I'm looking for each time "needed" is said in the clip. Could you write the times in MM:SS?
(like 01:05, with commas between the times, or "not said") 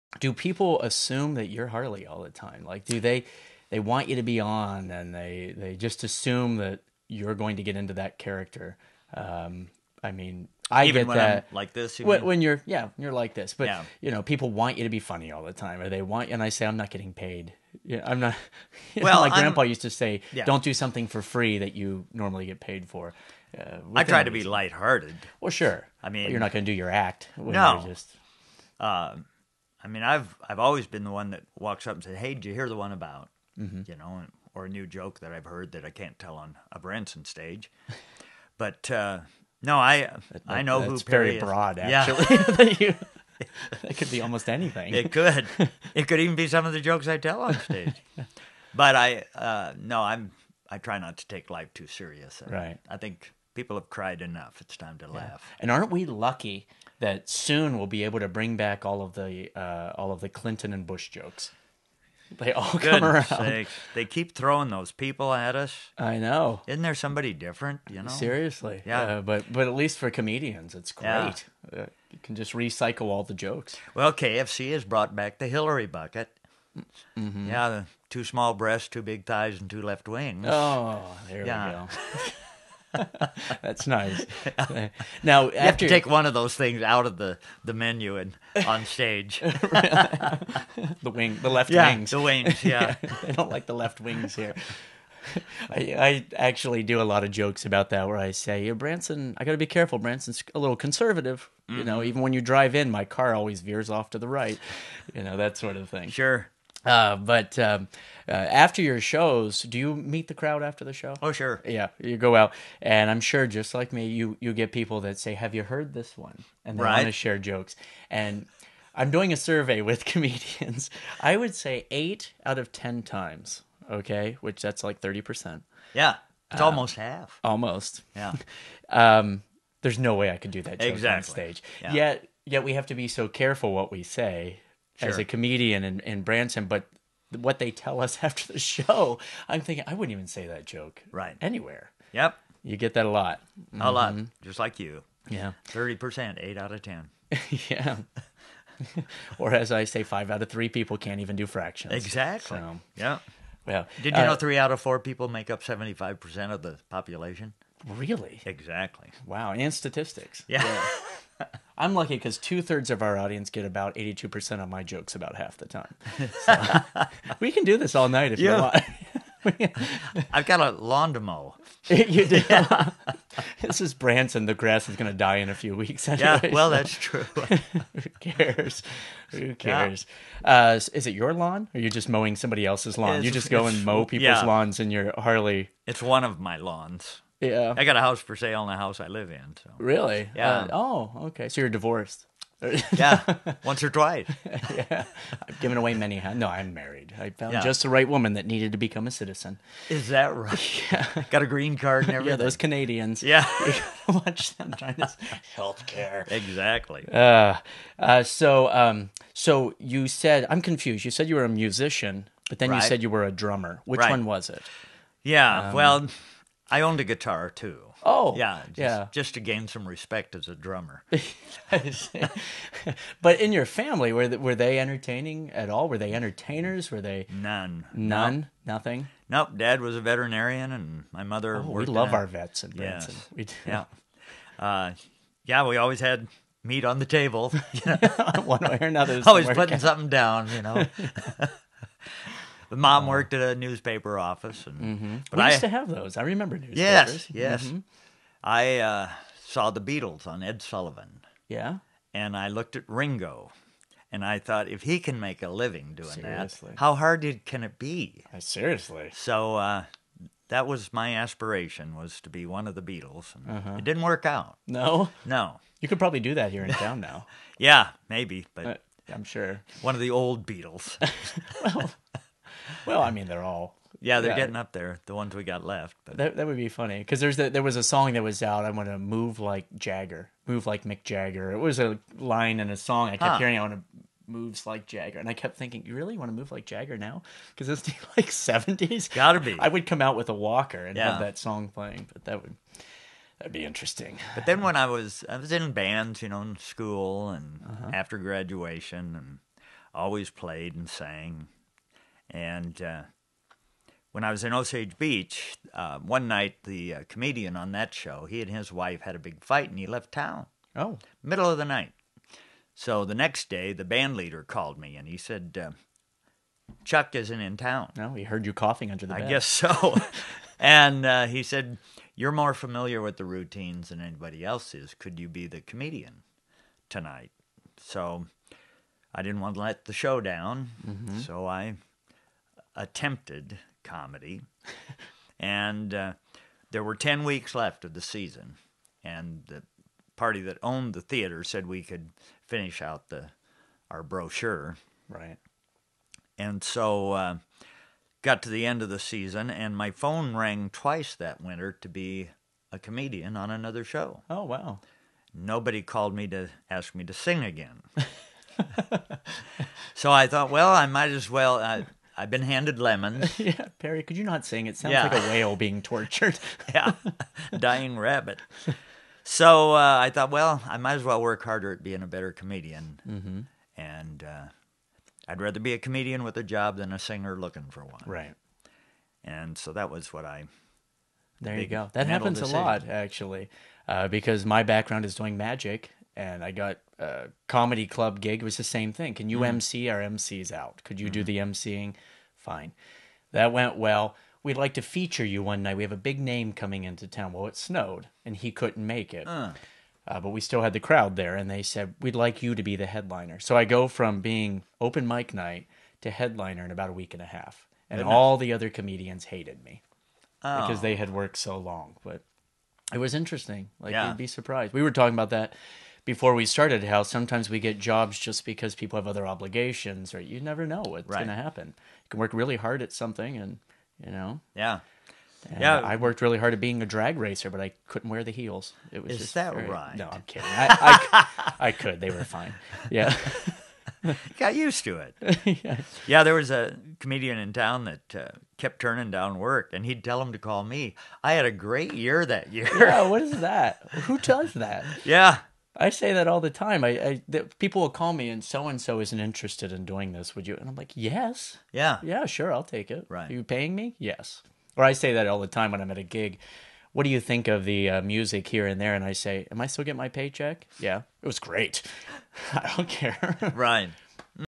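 03:18.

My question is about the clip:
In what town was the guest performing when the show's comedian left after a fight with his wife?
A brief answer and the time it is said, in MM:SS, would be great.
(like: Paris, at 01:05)
Osage Beach, at 05:04.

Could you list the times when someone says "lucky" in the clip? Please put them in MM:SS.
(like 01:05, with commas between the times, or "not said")
00:56, 02:41.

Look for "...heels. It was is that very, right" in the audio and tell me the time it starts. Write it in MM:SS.
07:08.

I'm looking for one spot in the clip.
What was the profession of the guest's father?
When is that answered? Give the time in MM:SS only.
03:50.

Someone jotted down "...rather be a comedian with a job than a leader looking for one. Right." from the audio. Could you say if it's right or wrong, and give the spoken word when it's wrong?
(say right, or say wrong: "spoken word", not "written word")
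wrong: "singer", not "leader".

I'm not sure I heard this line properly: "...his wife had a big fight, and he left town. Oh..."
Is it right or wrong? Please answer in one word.
right.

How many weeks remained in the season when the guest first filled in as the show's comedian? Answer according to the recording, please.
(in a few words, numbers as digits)
10.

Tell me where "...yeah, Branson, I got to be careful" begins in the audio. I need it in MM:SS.
01:38.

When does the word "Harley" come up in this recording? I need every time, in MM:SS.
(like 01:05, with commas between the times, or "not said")
00:01, 03:05.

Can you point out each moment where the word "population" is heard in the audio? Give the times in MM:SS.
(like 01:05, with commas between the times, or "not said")
02:36.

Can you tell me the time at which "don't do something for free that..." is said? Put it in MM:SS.
00:20.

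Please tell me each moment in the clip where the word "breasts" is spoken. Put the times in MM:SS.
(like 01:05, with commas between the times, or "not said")
01:18.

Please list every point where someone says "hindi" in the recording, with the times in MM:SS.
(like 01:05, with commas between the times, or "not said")
not said.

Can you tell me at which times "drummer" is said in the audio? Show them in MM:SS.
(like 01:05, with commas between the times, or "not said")
03:33, 03:40.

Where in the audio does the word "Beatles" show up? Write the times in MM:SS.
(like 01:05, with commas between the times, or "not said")
04:09, 04:22, 04:30.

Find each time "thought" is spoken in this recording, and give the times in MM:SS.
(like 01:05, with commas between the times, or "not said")
04:14, 06:00, 06:10.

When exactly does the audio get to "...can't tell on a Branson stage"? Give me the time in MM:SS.
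00:35.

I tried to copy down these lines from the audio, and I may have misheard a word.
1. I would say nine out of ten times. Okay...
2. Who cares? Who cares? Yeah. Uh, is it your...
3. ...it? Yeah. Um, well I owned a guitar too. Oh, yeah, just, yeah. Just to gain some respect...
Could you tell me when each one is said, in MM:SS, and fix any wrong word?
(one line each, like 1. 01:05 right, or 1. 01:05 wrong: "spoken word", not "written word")
1. 02:01 wrong: "eight", not "nine"
2. 02:57 right
3. 03:34 right.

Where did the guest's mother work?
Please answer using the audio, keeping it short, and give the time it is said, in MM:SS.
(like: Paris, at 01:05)
A newspaper office, at 04:03.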